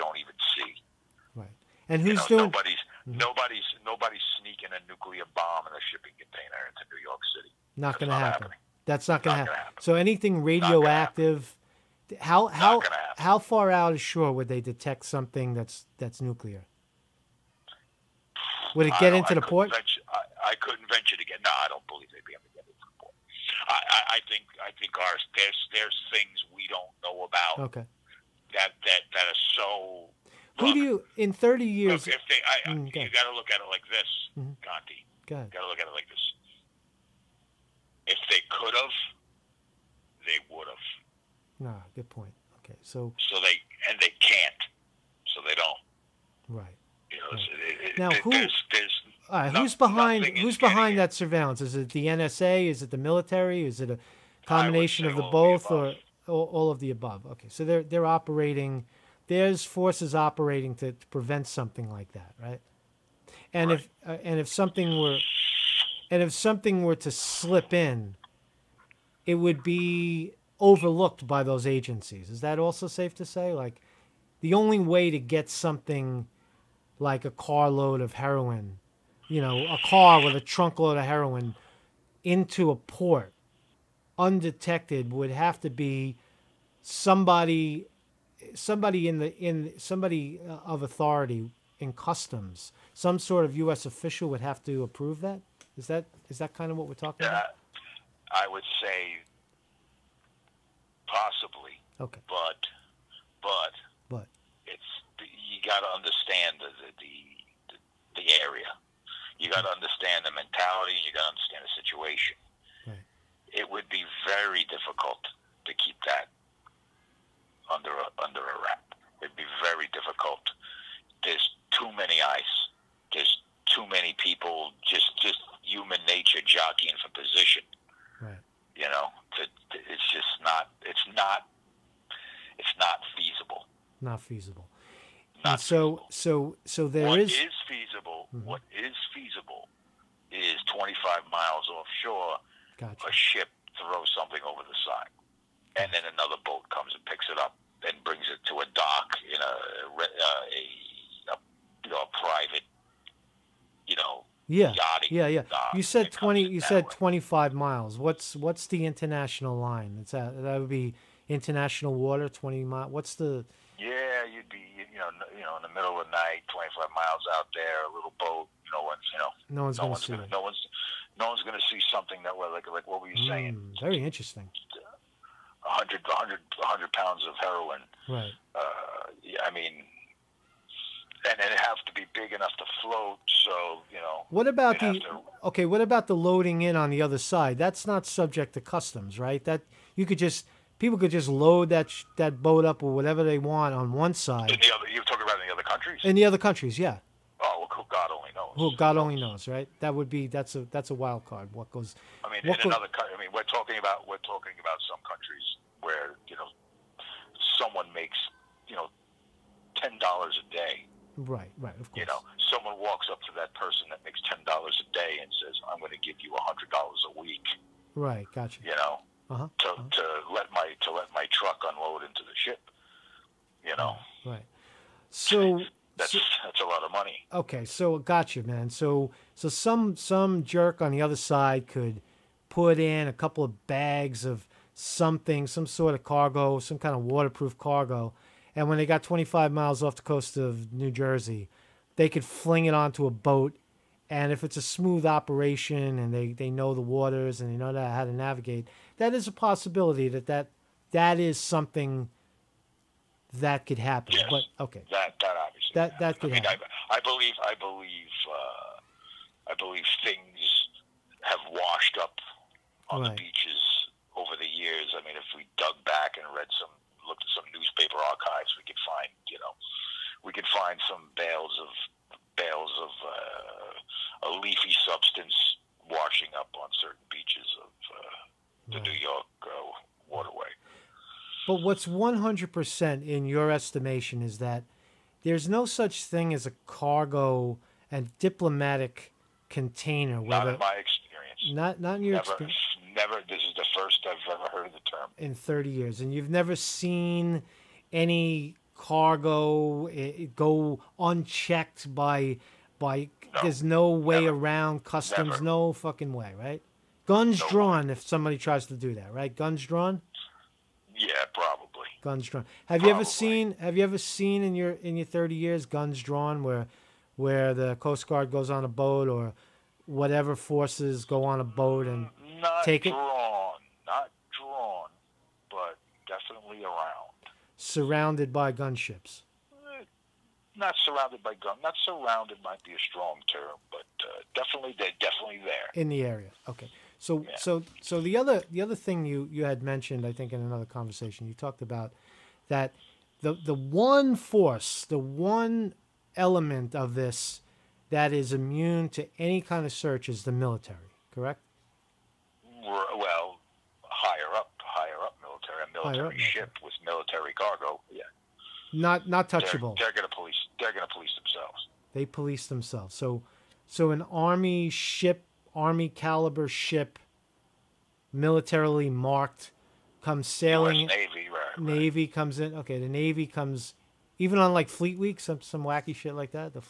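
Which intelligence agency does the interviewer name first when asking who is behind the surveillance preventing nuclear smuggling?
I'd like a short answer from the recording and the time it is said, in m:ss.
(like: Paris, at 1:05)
NSA, at 0:52.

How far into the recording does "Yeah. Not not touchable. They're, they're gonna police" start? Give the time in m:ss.
5:57.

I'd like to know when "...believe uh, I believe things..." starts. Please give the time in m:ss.
4:17.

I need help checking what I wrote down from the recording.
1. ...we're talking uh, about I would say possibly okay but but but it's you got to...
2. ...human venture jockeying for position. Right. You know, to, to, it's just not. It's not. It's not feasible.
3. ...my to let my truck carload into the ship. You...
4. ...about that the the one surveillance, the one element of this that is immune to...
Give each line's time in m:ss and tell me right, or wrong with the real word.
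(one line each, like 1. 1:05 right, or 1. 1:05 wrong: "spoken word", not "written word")
1. 1:36 right
2. 2:05 wrong: "nature", not "venture"
3. 3:40 wrong: "unload", not "carload"
4. 5:41 wrong: "force", not "surveillance".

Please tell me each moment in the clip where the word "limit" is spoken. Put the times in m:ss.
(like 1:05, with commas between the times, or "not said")
not said.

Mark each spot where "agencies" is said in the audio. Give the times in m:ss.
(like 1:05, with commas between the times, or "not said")
1:11.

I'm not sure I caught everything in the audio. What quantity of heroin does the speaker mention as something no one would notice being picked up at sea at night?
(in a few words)
100 pounds.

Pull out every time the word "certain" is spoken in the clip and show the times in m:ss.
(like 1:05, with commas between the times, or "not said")
4:36.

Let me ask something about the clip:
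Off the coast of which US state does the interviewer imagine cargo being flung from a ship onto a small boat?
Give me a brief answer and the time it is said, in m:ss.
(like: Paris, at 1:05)
New Jersey, at 4:00.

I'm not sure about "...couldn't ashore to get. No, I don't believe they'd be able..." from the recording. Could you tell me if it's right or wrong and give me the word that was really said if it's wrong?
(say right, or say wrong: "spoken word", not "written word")
wrong: "venture", not "ashore".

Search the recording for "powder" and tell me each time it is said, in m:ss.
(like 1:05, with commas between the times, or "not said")
not said.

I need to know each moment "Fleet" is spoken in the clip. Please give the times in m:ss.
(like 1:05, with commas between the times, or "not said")
6:14.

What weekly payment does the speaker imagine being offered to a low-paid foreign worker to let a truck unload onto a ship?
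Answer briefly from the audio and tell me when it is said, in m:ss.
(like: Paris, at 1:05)
$100, at 3:36.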